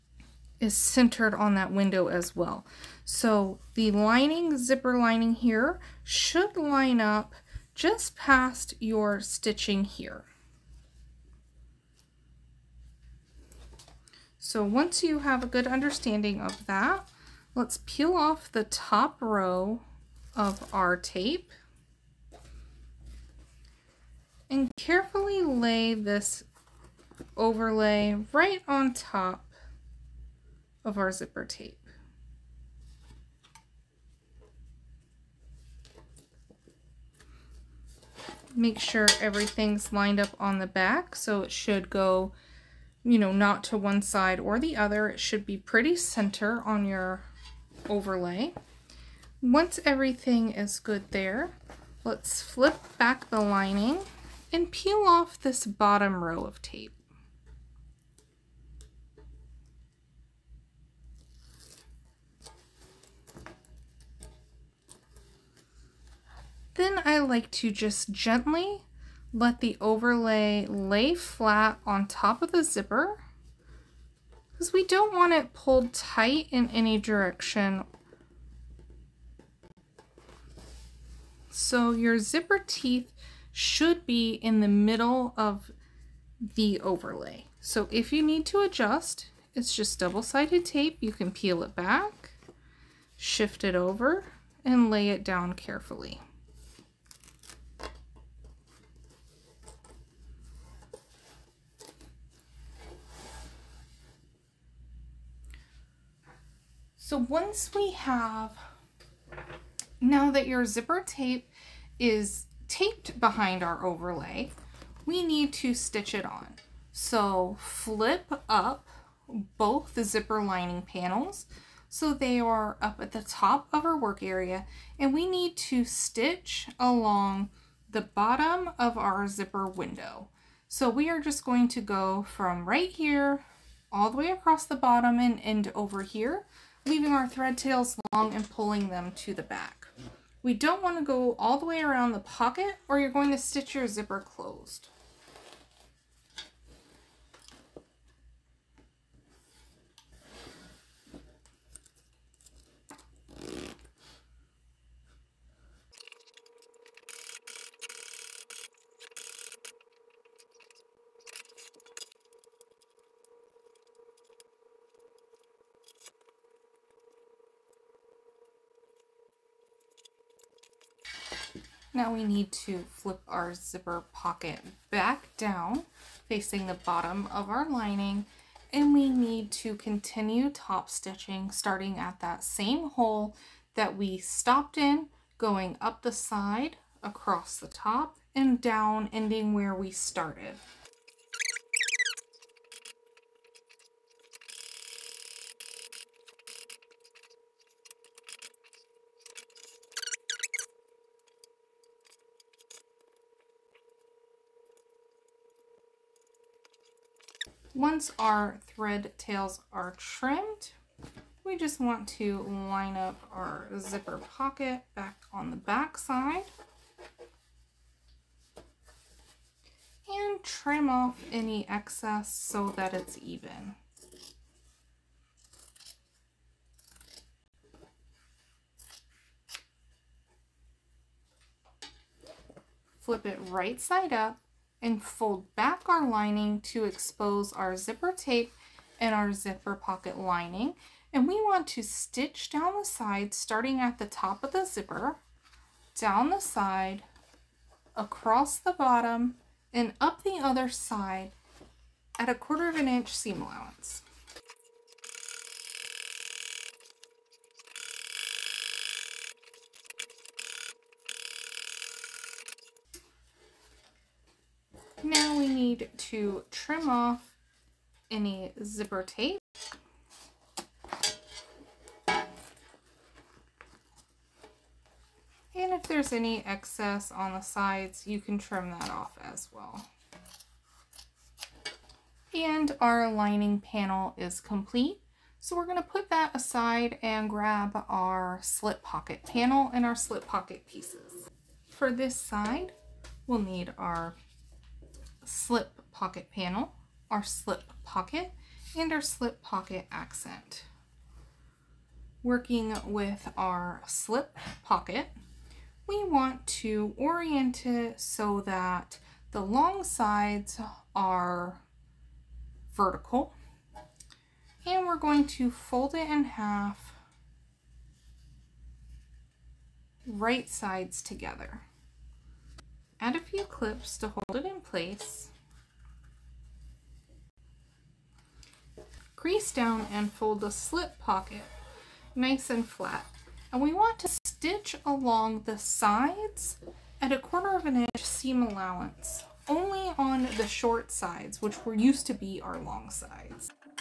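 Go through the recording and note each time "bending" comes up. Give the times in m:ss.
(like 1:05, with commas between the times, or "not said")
not said.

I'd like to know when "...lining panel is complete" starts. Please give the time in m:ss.
4:43.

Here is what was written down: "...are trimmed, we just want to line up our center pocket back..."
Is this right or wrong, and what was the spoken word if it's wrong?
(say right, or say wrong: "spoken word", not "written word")
wrong: "zipper", not "center".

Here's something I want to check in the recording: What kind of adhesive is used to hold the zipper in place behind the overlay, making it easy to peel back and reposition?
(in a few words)
double-sided tape.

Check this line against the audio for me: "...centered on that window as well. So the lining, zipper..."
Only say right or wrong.
right.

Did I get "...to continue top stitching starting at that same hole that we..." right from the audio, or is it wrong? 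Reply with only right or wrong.
right.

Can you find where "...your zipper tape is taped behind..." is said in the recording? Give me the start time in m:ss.
1:50.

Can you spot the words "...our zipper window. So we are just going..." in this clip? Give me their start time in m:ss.
2:08.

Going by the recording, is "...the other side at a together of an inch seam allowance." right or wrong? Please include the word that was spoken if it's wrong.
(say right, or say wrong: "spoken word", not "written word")
wrong: "quarter", not "together".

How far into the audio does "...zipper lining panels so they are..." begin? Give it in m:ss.
2:00.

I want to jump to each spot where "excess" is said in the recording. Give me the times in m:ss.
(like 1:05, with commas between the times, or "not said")
3:41, 4:36.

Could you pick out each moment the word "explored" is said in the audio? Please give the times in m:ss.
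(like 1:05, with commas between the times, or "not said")
not said.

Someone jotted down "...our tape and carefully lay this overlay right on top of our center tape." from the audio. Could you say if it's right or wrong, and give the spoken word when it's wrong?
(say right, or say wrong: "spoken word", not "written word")
wrong: "zipper", not "center".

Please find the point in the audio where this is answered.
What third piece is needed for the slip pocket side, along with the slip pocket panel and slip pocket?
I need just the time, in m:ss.
4:59.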